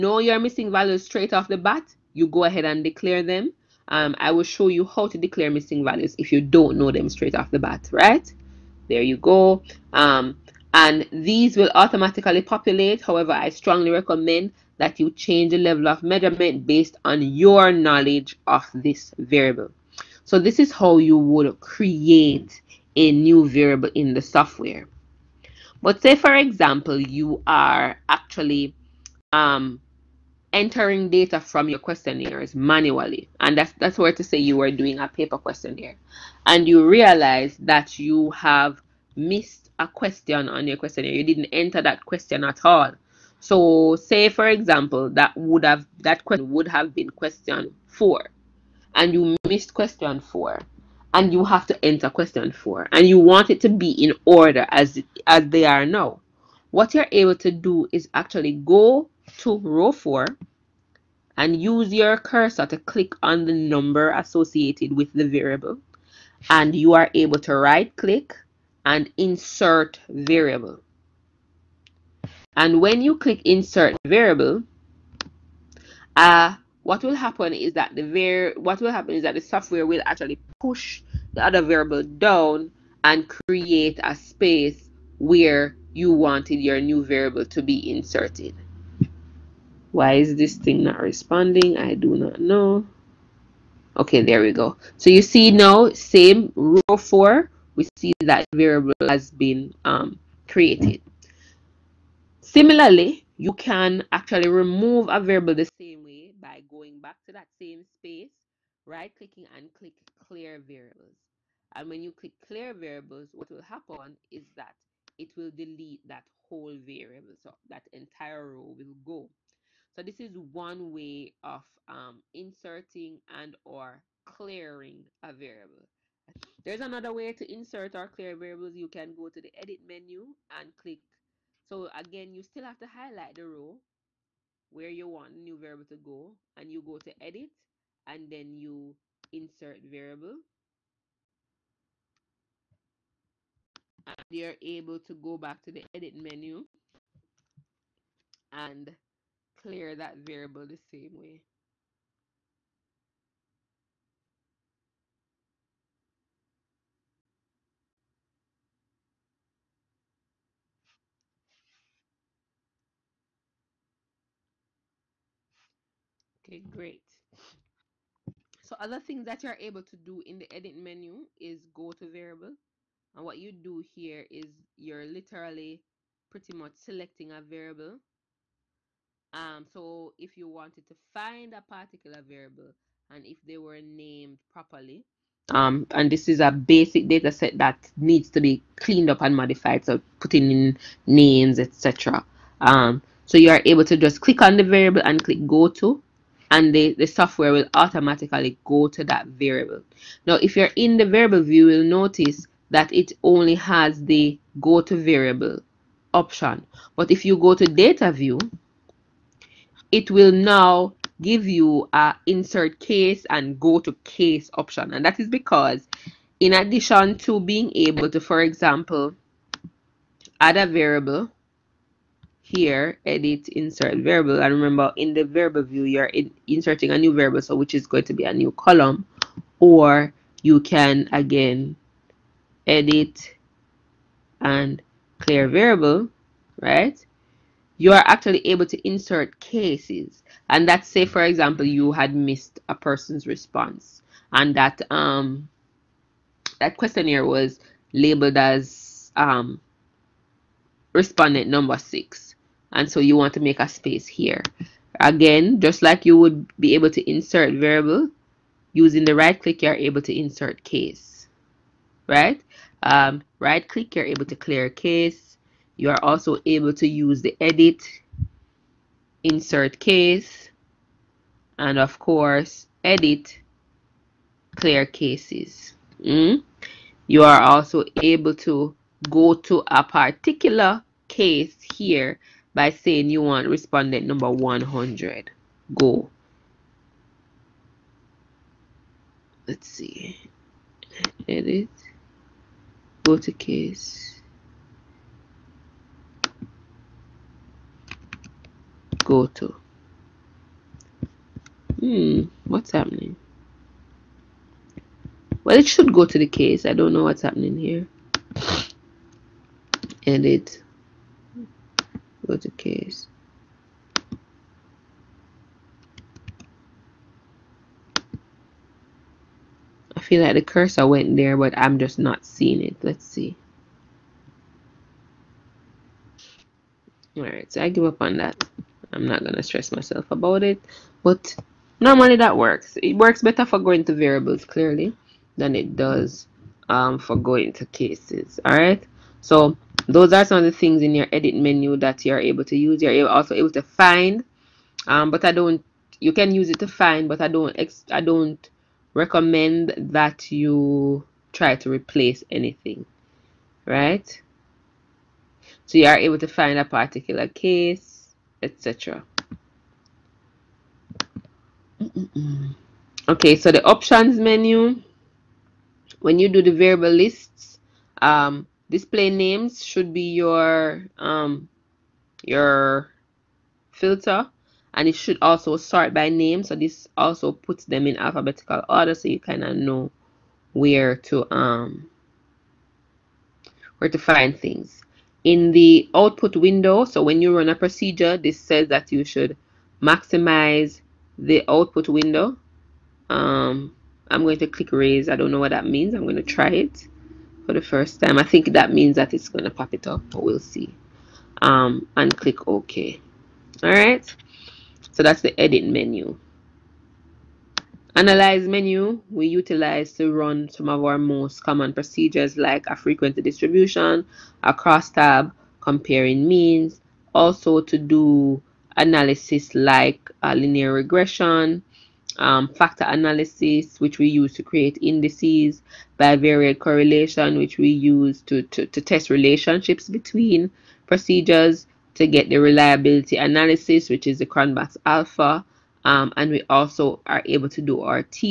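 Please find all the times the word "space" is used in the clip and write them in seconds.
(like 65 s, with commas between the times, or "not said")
84 s, 107 s, 253 s.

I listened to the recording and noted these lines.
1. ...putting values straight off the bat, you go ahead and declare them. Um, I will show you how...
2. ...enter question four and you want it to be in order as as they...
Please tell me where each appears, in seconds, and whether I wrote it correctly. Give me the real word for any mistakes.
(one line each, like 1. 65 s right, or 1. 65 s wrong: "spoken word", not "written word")
1. 0 s wrong: "missing", not "putting"
2. 51 s right.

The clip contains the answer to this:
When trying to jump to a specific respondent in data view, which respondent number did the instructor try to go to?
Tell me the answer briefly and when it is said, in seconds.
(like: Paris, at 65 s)
100, at 283 s.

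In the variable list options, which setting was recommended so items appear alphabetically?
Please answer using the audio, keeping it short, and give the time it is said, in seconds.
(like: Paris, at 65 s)
Sort by name, at 375 s.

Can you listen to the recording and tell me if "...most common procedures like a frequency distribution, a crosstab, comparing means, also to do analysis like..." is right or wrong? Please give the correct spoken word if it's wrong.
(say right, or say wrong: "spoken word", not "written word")
right.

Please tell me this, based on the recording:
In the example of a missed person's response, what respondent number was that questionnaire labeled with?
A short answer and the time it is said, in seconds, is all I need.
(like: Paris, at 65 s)
6, at 250 s.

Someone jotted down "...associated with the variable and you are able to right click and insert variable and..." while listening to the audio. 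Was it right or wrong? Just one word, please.
right.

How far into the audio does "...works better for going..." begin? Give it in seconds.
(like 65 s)
332 s.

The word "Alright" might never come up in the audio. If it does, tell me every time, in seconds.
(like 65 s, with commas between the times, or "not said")
327 s, 338 s, 403 s.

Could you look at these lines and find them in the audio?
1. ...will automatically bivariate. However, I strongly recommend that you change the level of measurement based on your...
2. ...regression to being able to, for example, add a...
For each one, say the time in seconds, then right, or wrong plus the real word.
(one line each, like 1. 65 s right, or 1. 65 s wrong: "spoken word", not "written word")
1. 11 s wrong: "populate", not "bivariate"
2. 216 s wrong: "addition", not "regression".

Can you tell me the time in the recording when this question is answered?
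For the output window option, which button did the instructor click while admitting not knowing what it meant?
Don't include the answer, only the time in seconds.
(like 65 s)
394 s.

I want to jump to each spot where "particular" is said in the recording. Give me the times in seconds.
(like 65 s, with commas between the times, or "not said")
181 s, 279 s, 356 s.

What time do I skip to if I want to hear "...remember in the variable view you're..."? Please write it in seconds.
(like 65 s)
224 s.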